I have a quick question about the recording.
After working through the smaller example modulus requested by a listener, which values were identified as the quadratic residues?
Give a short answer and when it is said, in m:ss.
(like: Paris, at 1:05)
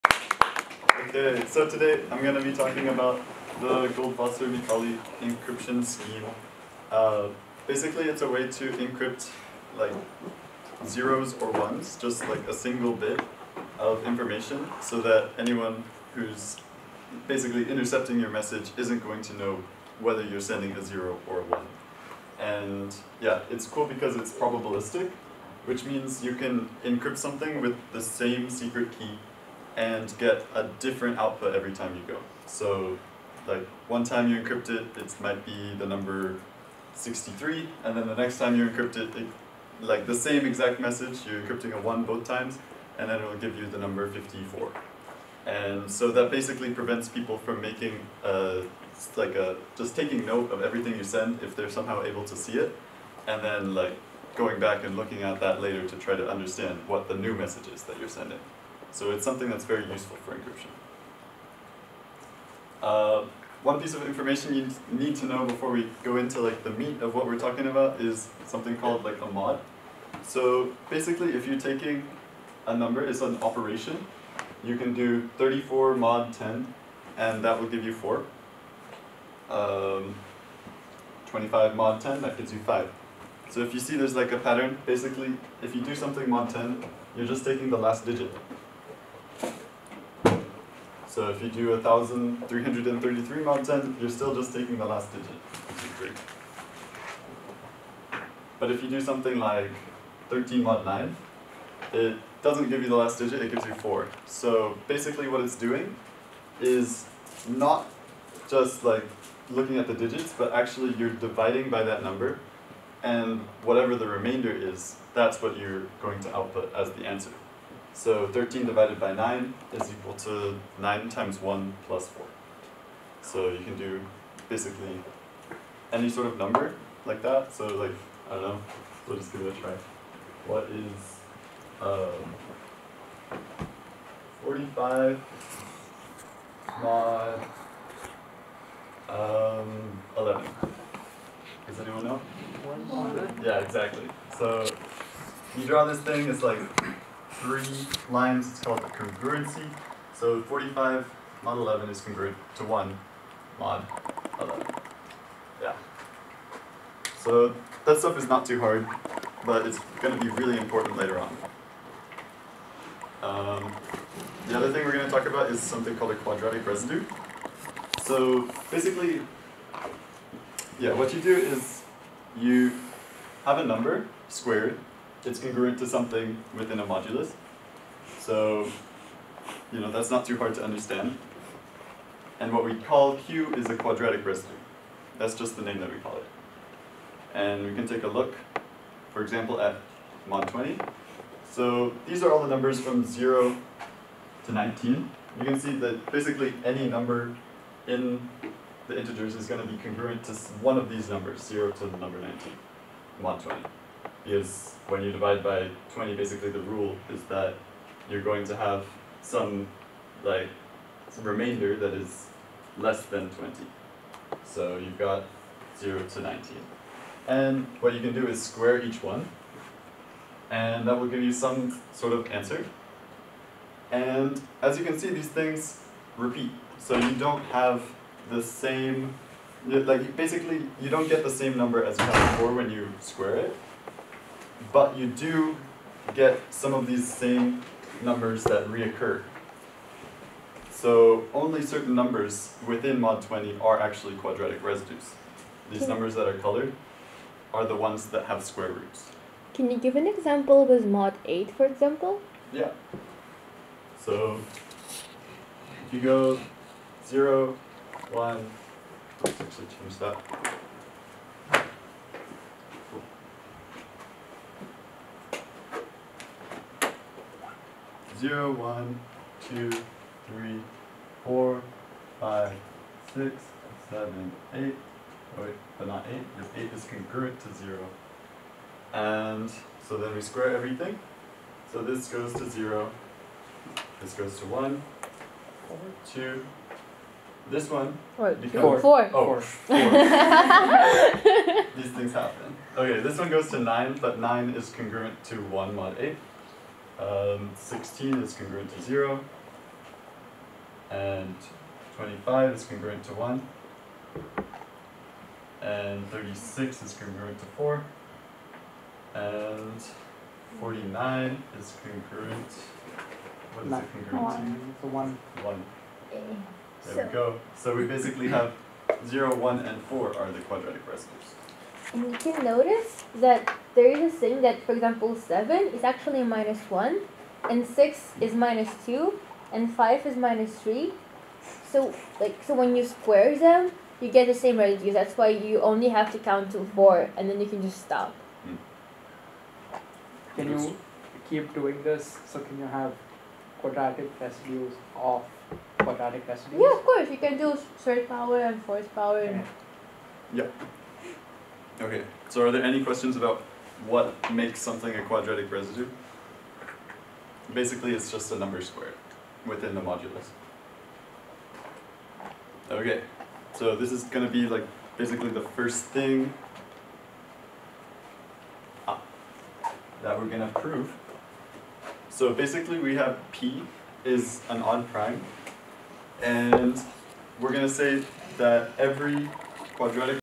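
0, 1, and 4, at 5:19.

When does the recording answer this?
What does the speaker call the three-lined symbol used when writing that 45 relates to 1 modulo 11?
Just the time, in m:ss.
2:28.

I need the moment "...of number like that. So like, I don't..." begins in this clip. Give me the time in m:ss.
2:06.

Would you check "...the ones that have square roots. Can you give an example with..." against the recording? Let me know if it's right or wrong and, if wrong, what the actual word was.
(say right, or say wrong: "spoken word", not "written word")
right.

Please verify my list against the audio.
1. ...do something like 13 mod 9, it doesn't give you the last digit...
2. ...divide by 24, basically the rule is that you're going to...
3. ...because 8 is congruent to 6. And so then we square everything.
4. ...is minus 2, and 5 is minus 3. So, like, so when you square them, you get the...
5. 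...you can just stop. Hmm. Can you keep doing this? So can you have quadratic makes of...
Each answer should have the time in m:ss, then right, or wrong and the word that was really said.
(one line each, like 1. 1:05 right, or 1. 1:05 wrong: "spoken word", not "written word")
1. 1:38 right
2. 3:25 wrong: "20", not "24"
3. 4:36 wrong: "0", not "6"
4. 5:28 right
5. 5:37 wrong: "residues", not "makes".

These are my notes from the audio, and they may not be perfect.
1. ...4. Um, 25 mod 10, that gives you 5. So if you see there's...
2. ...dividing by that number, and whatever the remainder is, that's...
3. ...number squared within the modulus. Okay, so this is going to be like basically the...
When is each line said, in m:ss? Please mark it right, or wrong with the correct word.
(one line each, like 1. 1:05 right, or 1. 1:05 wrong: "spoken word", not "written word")
1. 1:17 right
2. 1:51 right
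3. 5:58 right.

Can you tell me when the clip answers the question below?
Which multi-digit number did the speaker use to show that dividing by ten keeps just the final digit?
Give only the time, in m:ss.
1:31.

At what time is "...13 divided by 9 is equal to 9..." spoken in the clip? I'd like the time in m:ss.
1:58.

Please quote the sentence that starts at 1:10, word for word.
So basically, if you're taking a number, it's an operation.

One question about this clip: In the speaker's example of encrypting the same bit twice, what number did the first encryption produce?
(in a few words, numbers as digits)
63.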